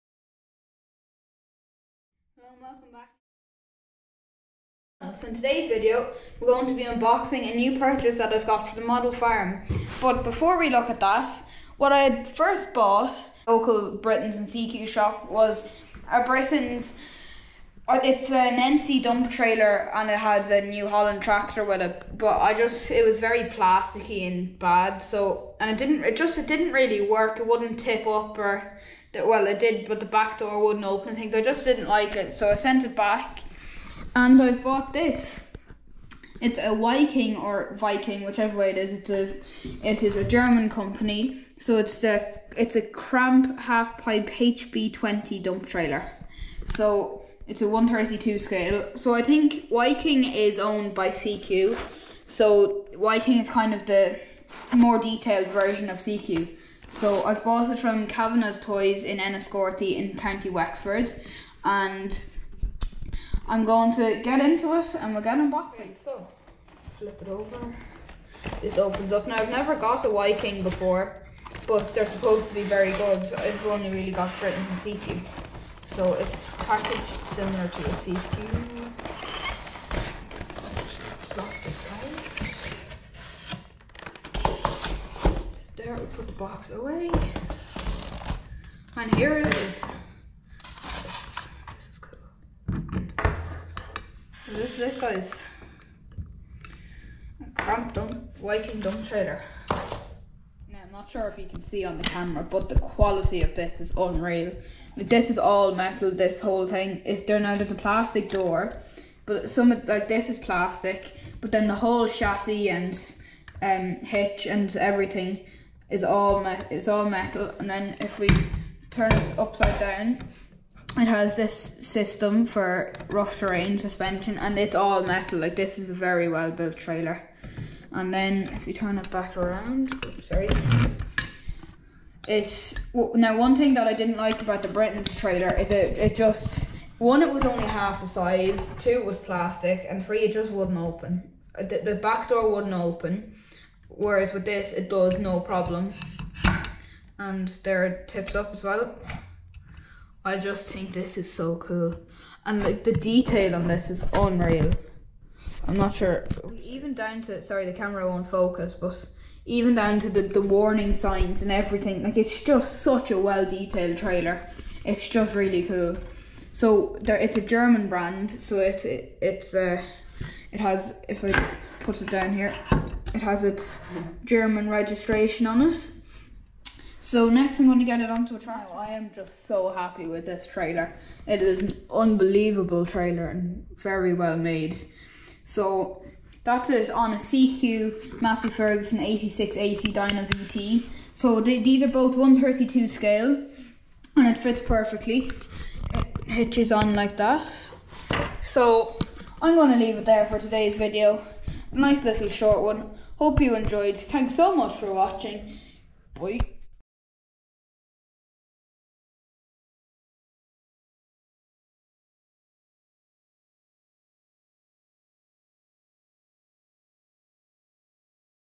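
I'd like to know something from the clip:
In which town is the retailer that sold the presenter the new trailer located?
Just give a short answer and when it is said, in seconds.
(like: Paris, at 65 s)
Enniscorthy, at 59 s.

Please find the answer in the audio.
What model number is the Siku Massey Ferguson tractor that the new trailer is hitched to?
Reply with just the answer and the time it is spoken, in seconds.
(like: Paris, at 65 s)
8680, at 188 s.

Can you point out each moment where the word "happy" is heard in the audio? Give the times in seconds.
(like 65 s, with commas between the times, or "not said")
179 s.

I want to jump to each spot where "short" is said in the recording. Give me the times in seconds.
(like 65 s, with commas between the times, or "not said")
202 s.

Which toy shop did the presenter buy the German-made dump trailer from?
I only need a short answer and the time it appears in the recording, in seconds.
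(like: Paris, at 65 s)
Kavanagh's Toys, at 58 s.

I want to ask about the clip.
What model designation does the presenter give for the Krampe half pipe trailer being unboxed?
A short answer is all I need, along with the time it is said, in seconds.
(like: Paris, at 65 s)
HB 20, at 44 s.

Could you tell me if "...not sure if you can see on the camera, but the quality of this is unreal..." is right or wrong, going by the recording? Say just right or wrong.
right.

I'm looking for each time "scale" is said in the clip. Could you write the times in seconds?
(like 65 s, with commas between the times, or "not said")
48 s, 192 s.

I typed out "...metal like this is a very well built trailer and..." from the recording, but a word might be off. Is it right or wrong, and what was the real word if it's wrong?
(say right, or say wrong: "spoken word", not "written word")
right.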